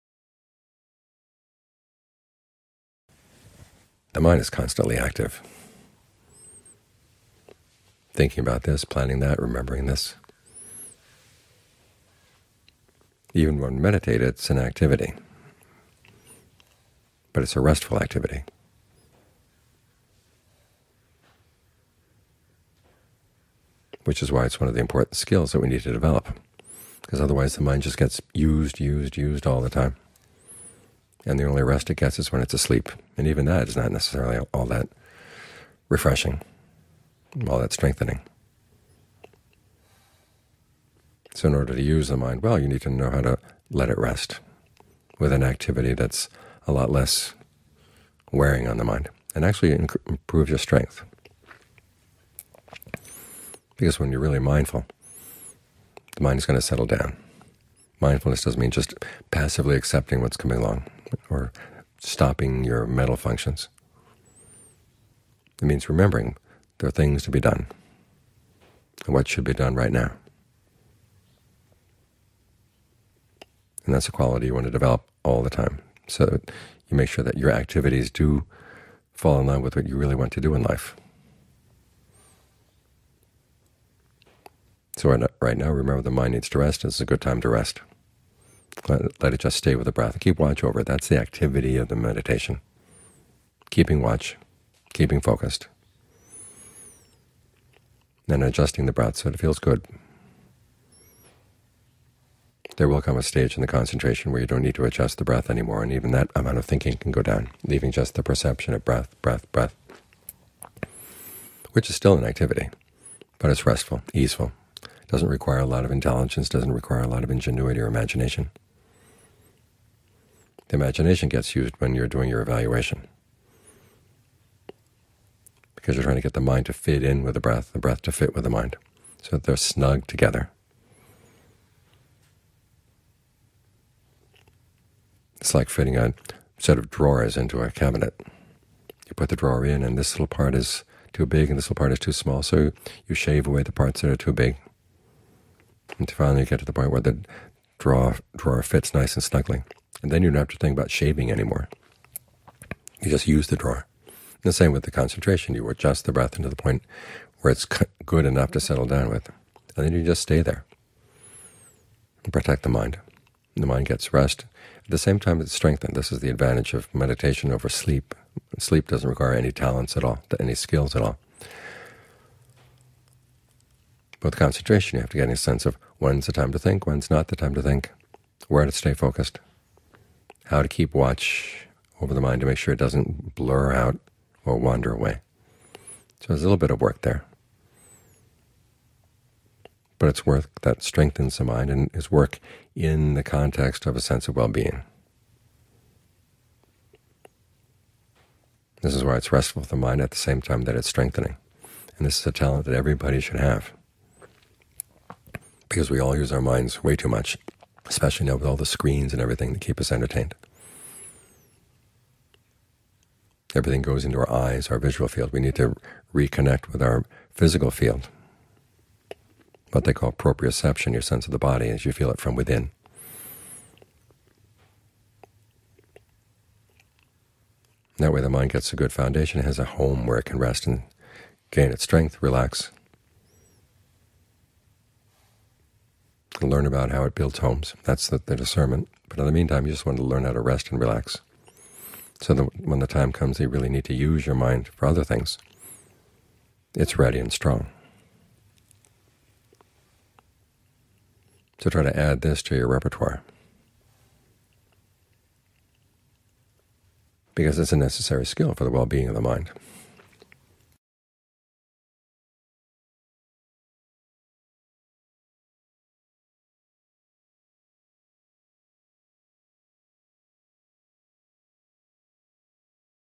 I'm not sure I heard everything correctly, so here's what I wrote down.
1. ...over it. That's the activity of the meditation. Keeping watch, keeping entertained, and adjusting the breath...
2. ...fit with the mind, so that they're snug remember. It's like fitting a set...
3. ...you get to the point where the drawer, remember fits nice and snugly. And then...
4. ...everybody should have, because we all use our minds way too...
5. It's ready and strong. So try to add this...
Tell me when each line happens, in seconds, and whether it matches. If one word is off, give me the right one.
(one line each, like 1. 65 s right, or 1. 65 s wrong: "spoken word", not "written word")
1. 90 s wrong: "focused", not "entertained"
2. 128 s wrong: "together", not "remember"
3. 146 s wrong: "drawer", not "remember"
4. 202 s right
5. 246 s right.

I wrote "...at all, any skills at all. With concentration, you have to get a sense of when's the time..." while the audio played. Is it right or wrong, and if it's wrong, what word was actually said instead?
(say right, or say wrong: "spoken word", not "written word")
right.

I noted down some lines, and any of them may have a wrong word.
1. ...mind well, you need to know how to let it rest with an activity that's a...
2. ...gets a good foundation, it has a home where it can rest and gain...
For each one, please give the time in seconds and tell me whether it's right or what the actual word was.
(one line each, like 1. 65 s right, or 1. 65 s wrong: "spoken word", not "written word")
1. 42 s right
2. 228 s right.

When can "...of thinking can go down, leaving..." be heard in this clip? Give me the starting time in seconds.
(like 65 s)
106 s.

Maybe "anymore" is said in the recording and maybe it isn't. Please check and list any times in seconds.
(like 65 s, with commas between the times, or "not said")
105 s, 151 s.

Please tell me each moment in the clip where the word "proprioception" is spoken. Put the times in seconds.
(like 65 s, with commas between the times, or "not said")
220 s.